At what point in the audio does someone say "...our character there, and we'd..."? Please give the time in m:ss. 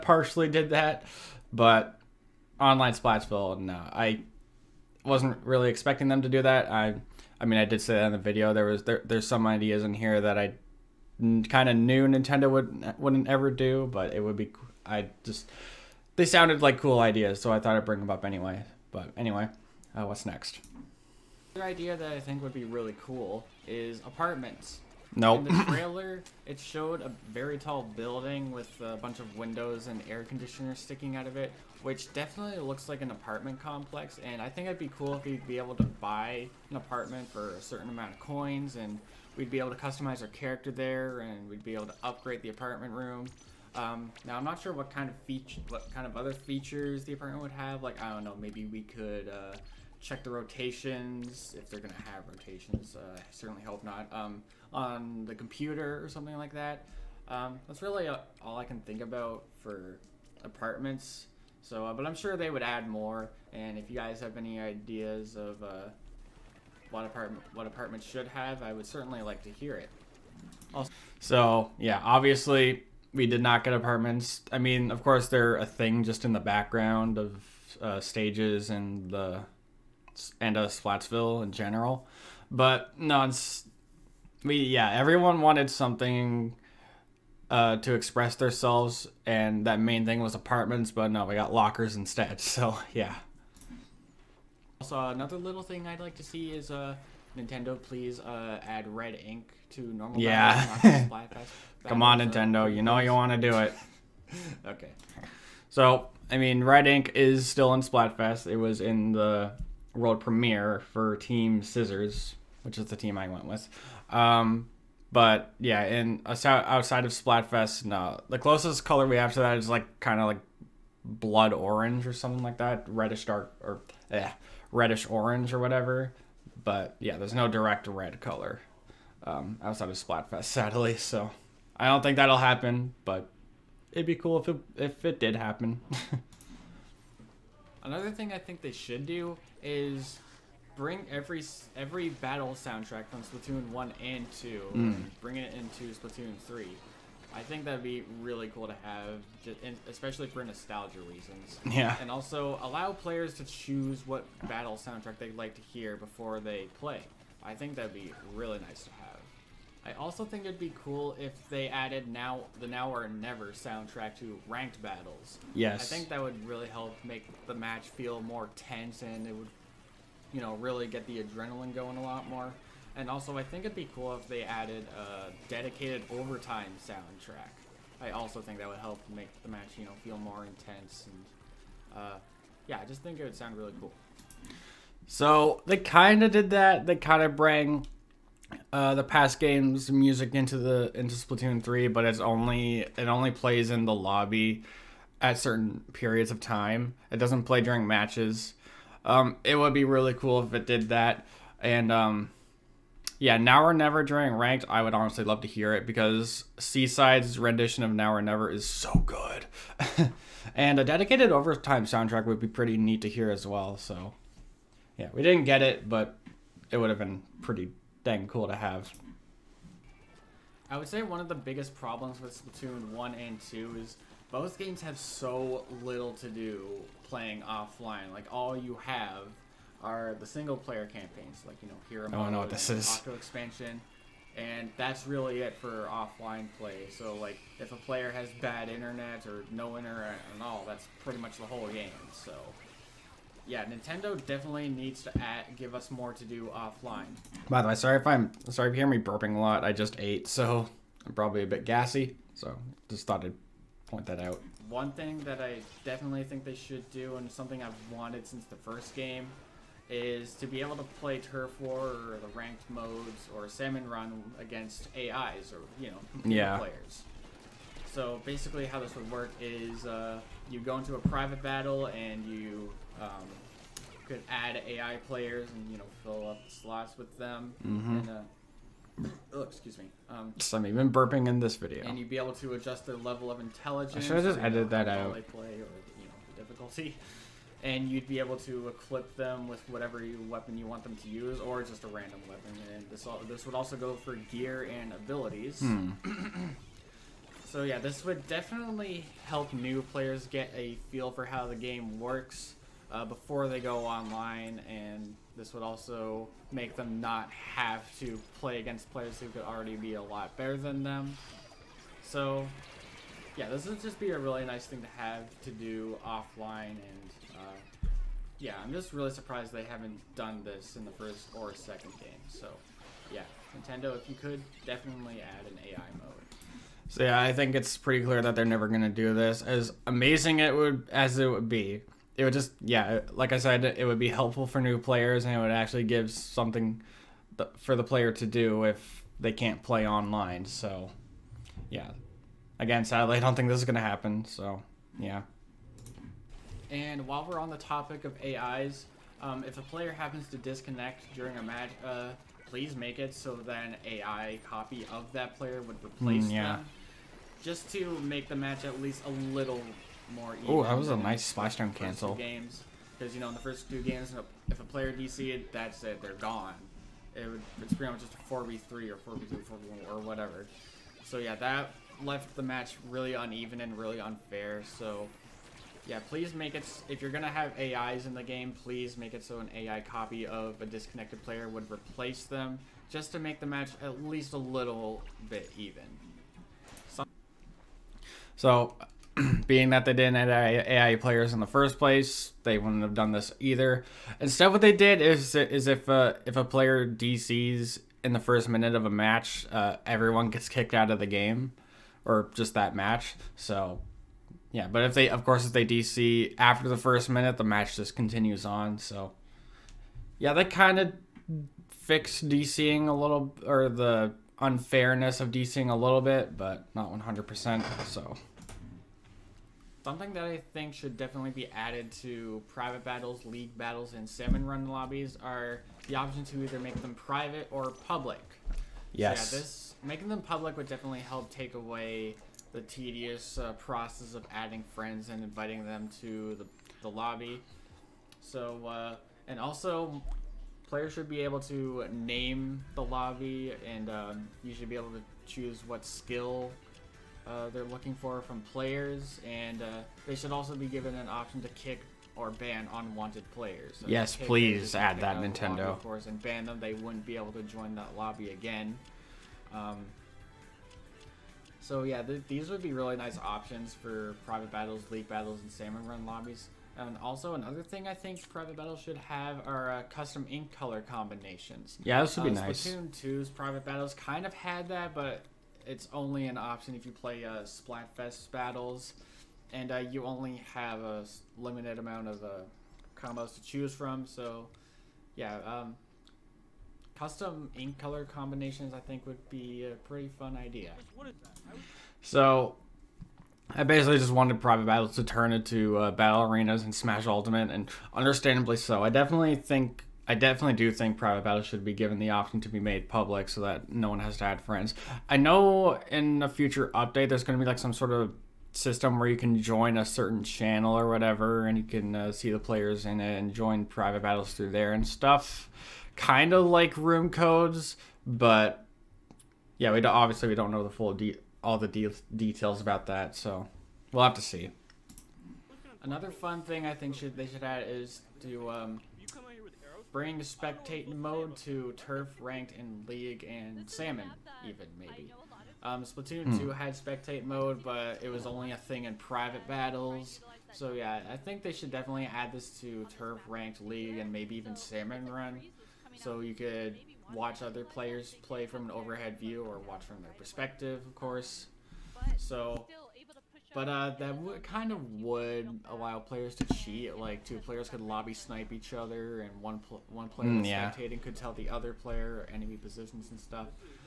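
0:40.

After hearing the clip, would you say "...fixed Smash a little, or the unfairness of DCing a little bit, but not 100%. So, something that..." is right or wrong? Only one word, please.
wrong.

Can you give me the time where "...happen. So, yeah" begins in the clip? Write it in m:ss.
5:43.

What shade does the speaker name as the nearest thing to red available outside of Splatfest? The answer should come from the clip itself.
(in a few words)
blood orange.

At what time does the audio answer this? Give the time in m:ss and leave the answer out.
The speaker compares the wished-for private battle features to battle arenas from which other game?
8:16.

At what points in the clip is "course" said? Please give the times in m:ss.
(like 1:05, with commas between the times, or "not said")
1:15, 6:45, 7:35, 9:10.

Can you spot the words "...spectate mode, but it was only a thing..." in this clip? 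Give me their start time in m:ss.
8:56.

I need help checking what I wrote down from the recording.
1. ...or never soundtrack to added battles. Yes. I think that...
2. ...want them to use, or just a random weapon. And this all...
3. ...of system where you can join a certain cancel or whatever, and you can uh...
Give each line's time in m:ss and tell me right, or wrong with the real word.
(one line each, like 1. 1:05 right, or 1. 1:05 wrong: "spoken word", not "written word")
1. 2:42 wrong: "ranked", not "added"
2. 4:50 right
3. 8:27 wrong: "channel", not "cancel".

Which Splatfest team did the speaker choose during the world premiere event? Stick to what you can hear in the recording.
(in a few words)
Team Scissors.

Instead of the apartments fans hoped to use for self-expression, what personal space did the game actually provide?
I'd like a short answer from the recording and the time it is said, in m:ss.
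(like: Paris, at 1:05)
lockers, at 1:31.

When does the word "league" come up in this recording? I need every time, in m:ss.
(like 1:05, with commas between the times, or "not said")
7:03, 7:44, 8:52, 9:03.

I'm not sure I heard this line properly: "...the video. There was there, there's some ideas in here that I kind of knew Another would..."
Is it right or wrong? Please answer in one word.
wrong.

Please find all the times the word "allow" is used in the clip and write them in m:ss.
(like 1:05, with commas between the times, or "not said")
2:32, 9:15.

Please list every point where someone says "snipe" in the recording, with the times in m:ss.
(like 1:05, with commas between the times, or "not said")
9:18.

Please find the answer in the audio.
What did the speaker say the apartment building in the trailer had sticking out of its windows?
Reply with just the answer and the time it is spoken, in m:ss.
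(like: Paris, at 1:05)
air conditioners, at 0:30.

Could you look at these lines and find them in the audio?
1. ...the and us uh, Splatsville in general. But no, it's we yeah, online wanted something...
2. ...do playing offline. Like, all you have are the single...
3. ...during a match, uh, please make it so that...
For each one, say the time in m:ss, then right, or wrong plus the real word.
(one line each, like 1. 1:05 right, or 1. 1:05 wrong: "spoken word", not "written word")
1. 1:19 wrong: "everyone", not "online"
2. 3:46 right
3. 5:51 right.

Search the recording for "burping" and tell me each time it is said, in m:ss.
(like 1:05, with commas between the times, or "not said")
4:08, 4:40.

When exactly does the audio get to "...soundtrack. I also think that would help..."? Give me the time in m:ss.
2:56.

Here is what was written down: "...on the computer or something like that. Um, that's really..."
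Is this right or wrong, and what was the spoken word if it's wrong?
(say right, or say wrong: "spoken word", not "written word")
right.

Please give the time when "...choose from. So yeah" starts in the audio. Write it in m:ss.
8:03.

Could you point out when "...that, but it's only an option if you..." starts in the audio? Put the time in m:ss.
7:54.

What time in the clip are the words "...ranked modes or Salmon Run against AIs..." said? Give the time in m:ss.
4:22.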